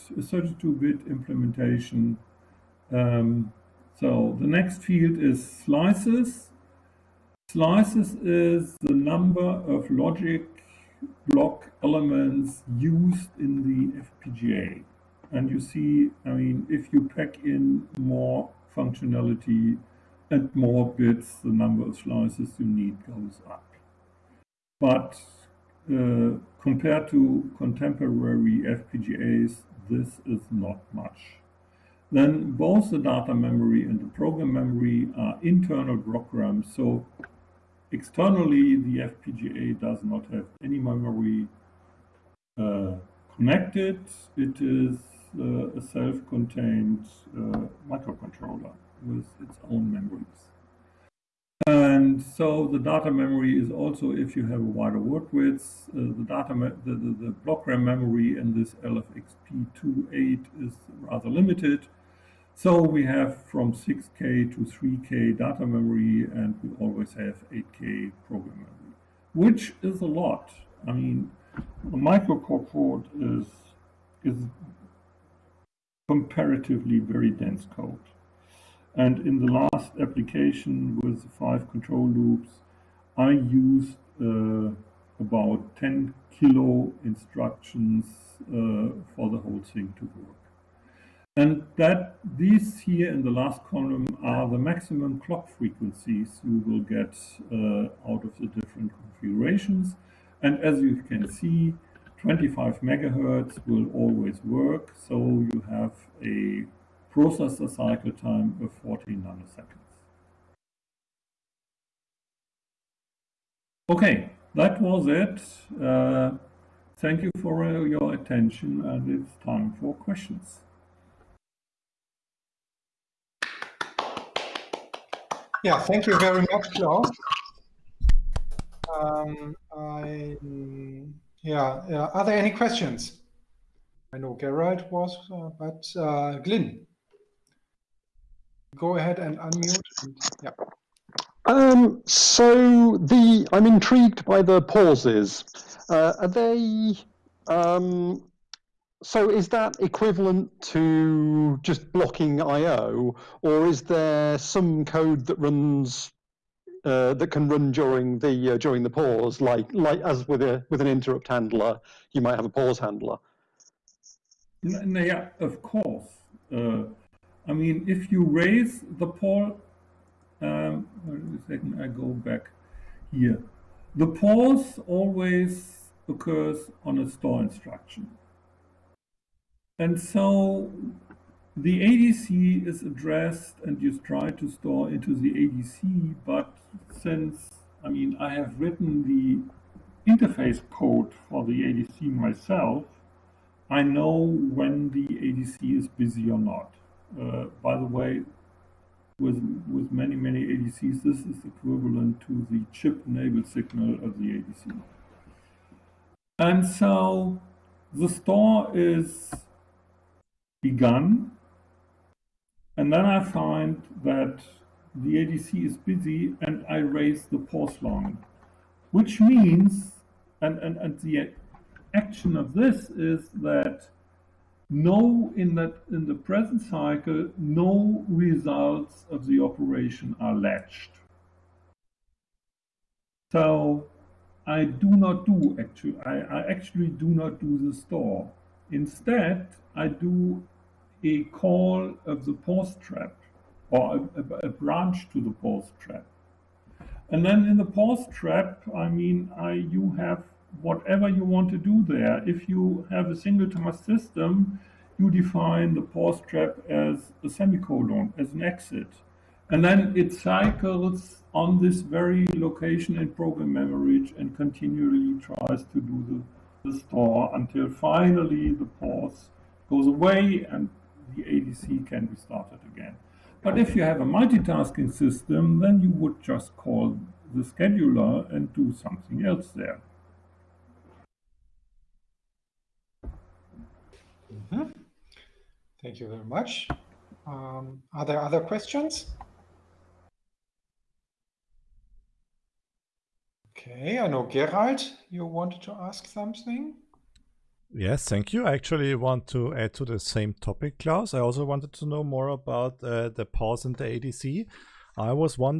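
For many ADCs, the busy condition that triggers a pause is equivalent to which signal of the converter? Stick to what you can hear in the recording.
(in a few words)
chip-enabled signal.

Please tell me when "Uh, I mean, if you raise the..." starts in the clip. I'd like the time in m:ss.
2:46.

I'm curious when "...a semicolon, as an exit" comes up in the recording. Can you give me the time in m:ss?
4:17.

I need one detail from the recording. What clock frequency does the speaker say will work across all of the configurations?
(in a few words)
25 megahertz.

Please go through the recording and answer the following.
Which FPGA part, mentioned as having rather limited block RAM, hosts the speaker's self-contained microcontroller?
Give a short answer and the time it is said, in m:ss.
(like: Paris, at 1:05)
LFXP28, at 0:58.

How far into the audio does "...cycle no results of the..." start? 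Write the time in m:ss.
3:46.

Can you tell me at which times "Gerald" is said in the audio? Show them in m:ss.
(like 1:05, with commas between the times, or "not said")
2:14, 4:54.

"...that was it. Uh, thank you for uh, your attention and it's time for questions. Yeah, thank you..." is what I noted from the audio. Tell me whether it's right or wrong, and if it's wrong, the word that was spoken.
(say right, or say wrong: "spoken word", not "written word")
right.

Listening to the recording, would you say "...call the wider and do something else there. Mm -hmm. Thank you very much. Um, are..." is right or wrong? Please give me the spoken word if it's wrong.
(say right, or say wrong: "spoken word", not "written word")
wrong: "scheduler", not "wider".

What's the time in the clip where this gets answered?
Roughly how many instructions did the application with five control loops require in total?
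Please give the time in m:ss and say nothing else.
1:25.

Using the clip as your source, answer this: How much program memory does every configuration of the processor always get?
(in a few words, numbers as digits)
8K.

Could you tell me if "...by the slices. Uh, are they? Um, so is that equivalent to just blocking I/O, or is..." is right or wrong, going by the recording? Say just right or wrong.
wrong.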